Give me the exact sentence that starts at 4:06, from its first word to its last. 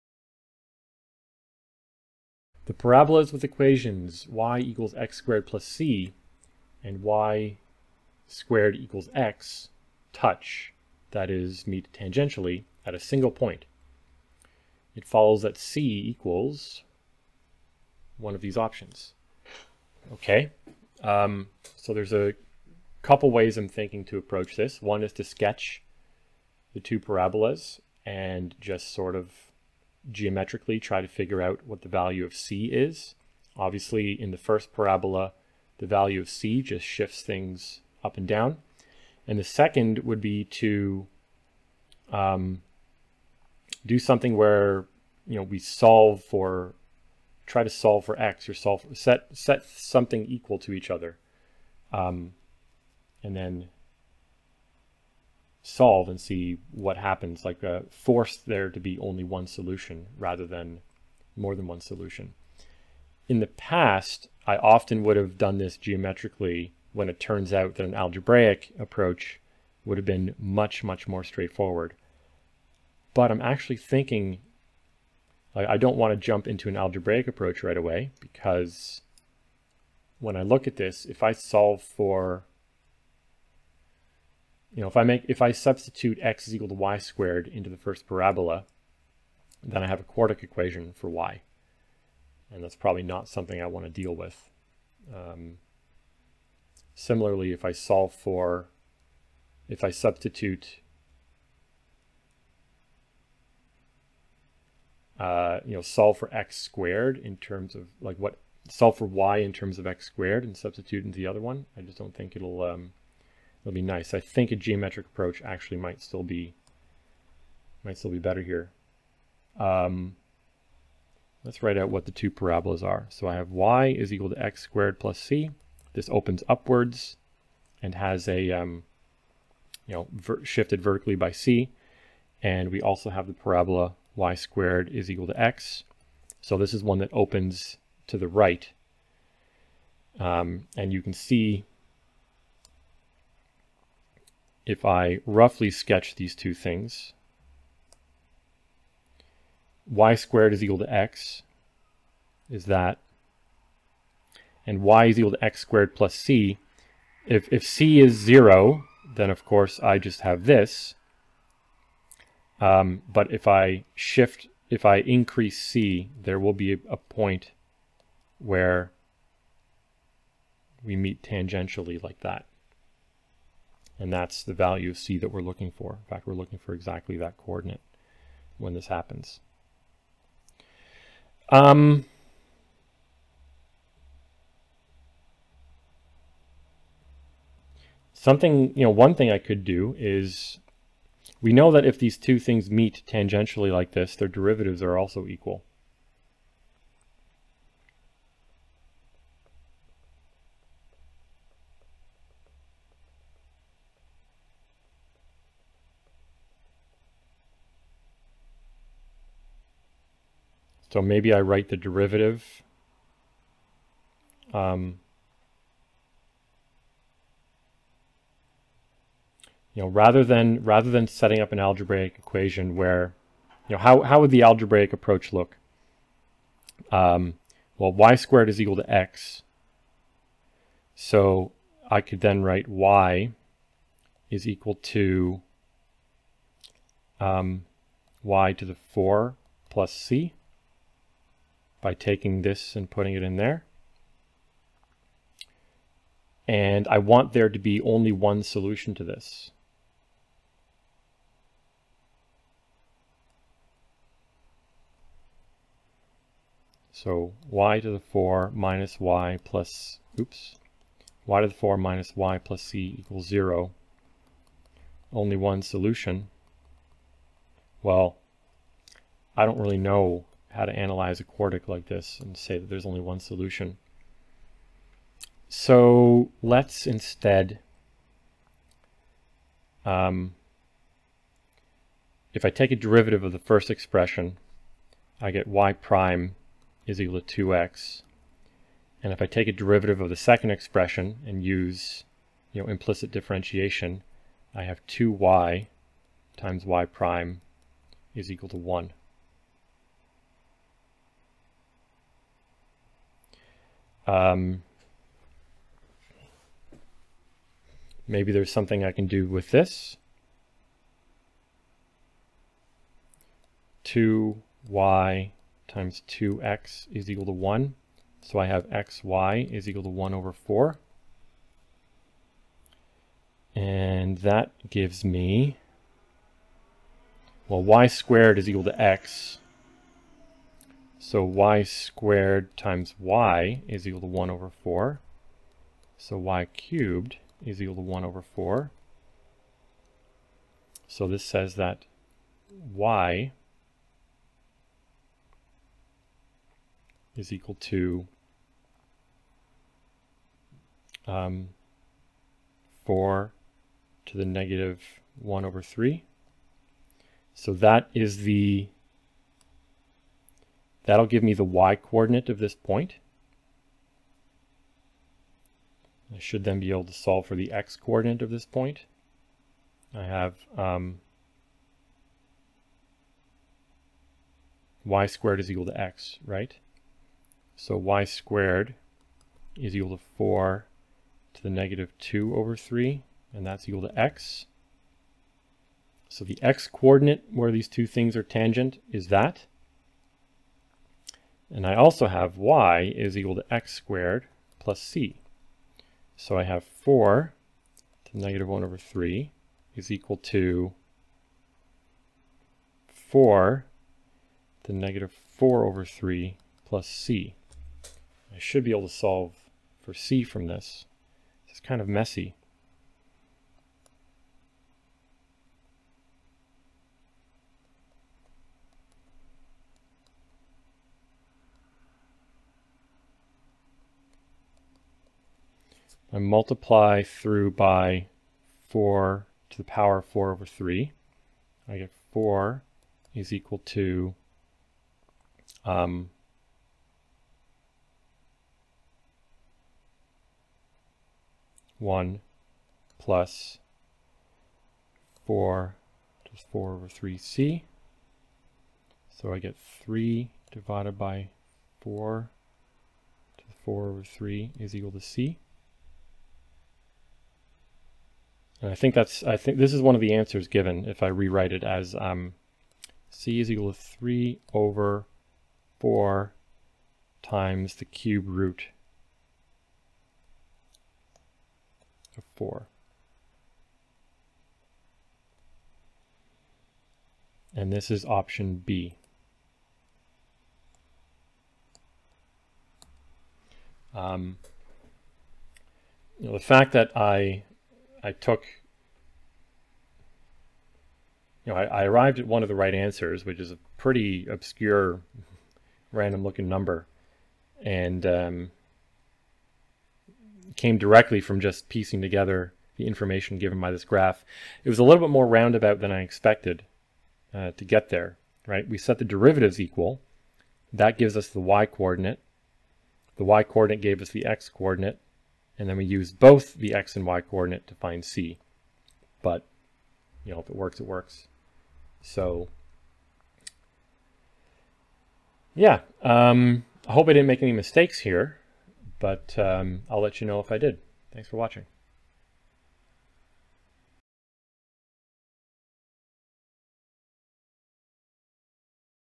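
And I want there to be only one solution to this.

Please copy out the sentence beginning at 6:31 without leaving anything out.
And I also have y is equal to x squared plus c.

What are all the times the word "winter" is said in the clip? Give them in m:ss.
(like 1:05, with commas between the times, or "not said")
not said.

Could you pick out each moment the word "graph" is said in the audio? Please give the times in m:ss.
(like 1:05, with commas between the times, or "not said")
8:23.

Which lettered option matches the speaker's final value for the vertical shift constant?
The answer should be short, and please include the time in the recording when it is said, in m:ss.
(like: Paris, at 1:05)
B, at 7:58.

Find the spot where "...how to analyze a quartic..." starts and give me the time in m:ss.
4:30.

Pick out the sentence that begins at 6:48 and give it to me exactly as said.
I should be able to solve for c from this.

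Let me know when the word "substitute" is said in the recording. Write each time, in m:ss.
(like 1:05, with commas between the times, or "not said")
1:25, 1:39, 1:50.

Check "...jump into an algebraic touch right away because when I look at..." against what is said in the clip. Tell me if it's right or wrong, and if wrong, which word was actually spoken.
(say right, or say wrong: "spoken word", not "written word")
wrong: "approach", not "touch".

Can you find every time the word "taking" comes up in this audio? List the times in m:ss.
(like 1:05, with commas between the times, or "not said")
4:01.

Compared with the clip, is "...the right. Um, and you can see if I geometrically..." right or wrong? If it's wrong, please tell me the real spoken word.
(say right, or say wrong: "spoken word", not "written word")
wrong: "roughly", not "geometrically".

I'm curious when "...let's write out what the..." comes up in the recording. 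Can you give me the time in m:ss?
2:01.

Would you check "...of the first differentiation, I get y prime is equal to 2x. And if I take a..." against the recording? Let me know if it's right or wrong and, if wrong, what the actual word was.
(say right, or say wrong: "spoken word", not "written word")
wrong: "expression", not "differentiation".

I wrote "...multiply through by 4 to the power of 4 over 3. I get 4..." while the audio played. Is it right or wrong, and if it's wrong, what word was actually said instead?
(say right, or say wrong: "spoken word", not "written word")
right.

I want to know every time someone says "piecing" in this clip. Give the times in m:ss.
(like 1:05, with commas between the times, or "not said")
8:21.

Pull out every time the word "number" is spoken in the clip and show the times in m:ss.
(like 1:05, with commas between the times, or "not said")
8:16.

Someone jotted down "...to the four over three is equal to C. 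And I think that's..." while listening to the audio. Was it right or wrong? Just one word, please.
right.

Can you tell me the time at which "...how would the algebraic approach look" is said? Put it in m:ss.
3:44.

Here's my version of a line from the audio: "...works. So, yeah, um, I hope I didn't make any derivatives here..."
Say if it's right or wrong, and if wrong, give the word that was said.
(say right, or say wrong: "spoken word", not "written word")
wrong: "mistakes", not "derivatives".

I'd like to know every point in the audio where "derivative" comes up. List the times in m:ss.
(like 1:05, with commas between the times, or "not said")
3:14, 3:31, 4:42, 4:49, 8:29.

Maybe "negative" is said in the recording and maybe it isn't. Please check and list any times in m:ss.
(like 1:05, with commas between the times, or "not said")
5:54, 6:21, 6:38, 6:44.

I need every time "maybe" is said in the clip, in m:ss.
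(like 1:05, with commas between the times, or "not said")
3:31, 5:08.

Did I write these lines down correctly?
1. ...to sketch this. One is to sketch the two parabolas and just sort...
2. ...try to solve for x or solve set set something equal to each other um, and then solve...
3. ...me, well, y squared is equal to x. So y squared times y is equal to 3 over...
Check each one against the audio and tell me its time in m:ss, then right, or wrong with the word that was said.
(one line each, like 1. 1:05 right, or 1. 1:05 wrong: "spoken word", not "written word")
1. 0:24 wrong: "approach", not "sketch"
2. 0:47 right
3. 5:25 wrong: "1", not "3".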